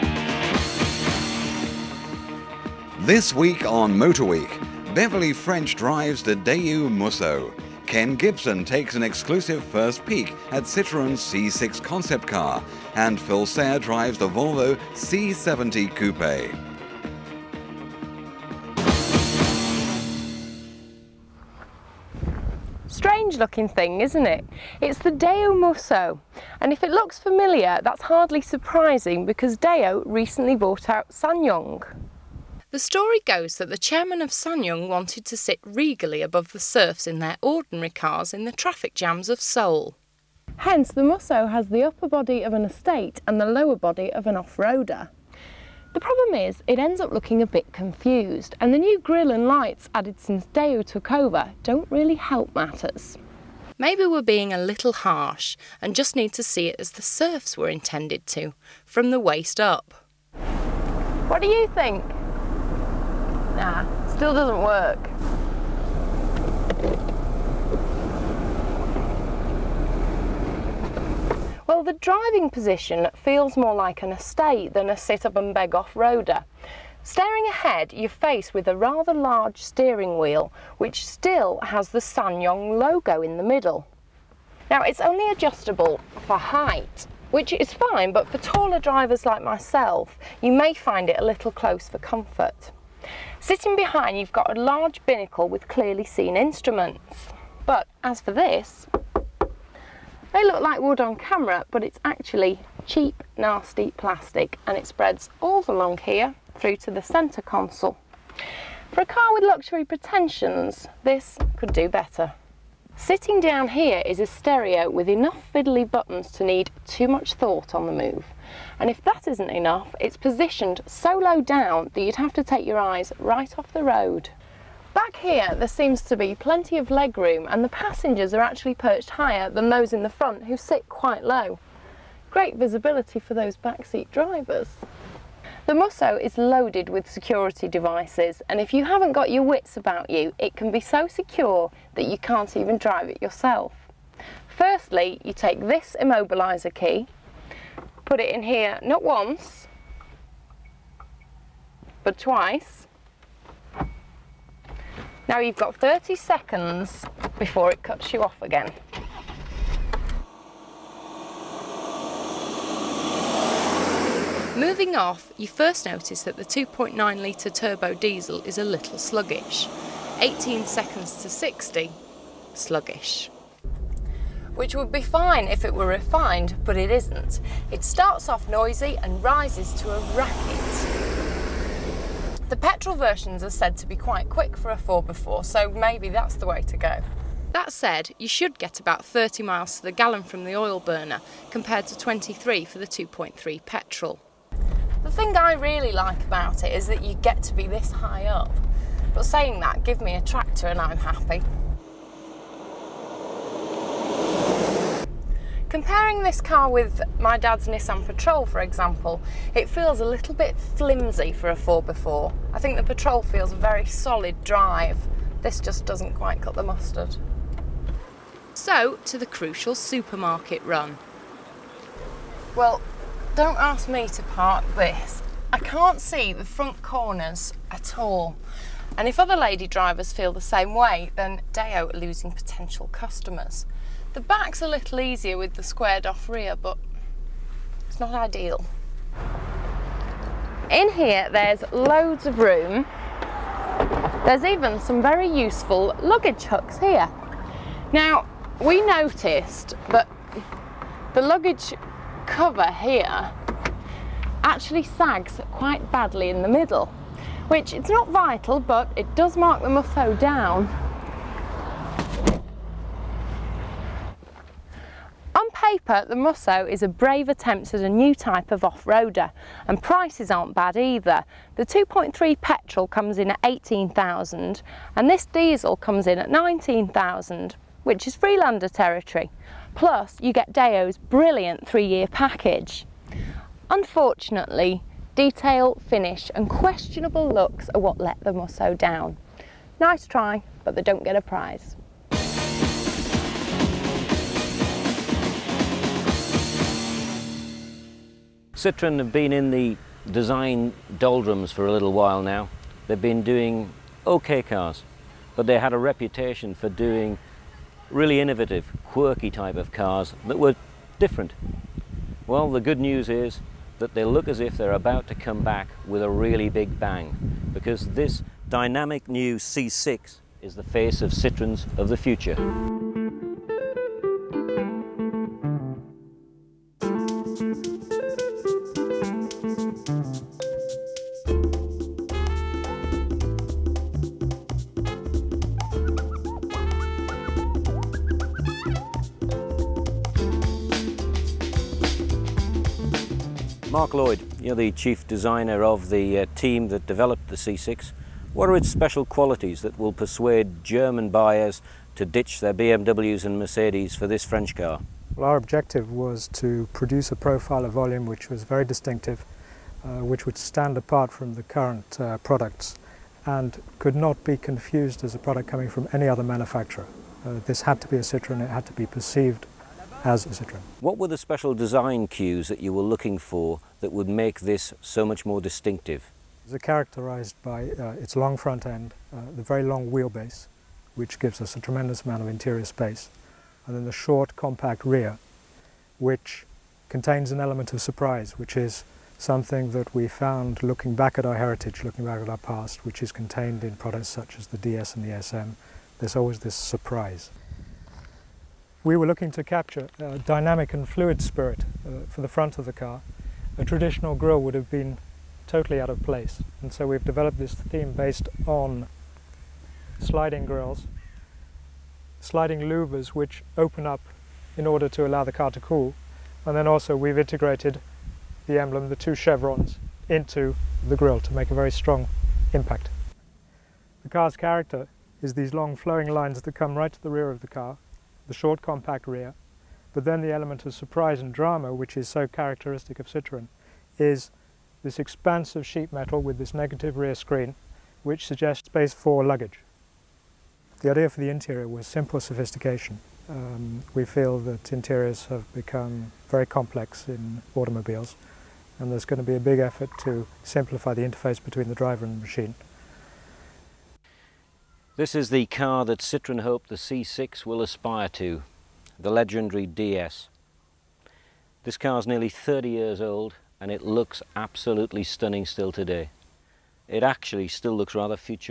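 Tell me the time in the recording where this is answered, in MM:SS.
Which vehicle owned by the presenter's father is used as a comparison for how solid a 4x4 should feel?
03:27.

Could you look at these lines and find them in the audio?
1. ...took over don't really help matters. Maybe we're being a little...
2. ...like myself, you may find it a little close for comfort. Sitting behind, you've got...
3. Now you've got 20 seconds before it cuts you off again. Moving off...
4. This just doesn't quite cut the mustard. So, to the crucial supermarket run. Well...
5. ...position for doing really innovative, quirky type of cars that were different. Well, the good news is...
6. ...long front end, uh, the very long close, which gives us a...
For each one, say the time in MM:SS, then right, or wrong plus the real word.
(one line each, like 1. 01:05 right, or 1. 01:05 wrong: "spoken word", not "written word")
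1. 00:50 right
2. 01:29 right
3. 02:35 wrong: "30", not "20"
4. 03:35 right
5. 05:05 wrong: "reputation", not "position"
6. 06:18 wrong: "wheelbase", not "close".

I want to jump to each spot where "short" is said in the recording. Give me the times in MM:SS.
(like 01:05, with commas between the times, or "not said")
06:23, 07:08.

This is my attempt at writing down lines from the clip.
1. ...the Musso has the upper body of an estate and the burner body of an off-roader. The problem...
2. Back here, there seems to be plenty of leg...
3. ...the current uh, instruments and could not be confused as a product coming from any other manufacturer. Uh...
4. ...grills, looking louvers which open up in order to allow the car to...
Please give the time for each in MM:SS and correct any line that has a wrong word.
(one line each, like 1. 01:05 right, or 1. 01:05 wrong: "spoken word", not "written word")
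1. 00:40 wrong: "lower", not "burner"
2. 02:04 right
3. 06:01 wrong: "products", not "instruments"
4. 06:50 wrong: "sliding", not "looking".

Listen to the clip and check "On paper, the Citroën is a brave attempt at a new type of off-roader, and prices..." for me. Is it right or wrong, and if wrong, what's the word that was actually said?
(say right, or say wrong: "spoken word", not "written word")
wrong: "Musso", not "Citroën".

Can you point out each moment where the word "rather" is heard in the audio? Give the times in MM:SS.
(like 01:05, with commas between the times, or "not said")
01:18, 07:47.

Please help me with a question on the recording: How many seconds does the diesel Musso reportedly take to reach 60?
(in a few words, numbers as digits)
18.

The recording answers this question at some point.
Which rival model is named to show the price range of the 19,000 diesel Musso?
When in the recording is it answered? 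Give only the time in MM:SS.
04:38.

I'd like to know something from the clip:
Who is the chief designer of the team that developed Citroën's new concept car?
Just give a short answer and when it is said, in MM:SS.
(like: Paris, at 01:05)
Mark Lloyd, at 05:43.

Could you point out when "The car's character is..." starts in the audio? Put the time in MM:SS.
07:04.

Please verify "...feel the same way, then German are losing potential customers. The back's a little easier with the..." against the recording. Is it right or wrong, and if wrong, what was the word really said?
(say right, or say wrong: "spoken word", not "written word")
wrong: "Daewoo", not "German".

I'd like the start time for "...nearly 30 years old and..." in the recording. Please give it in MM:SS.
07:42.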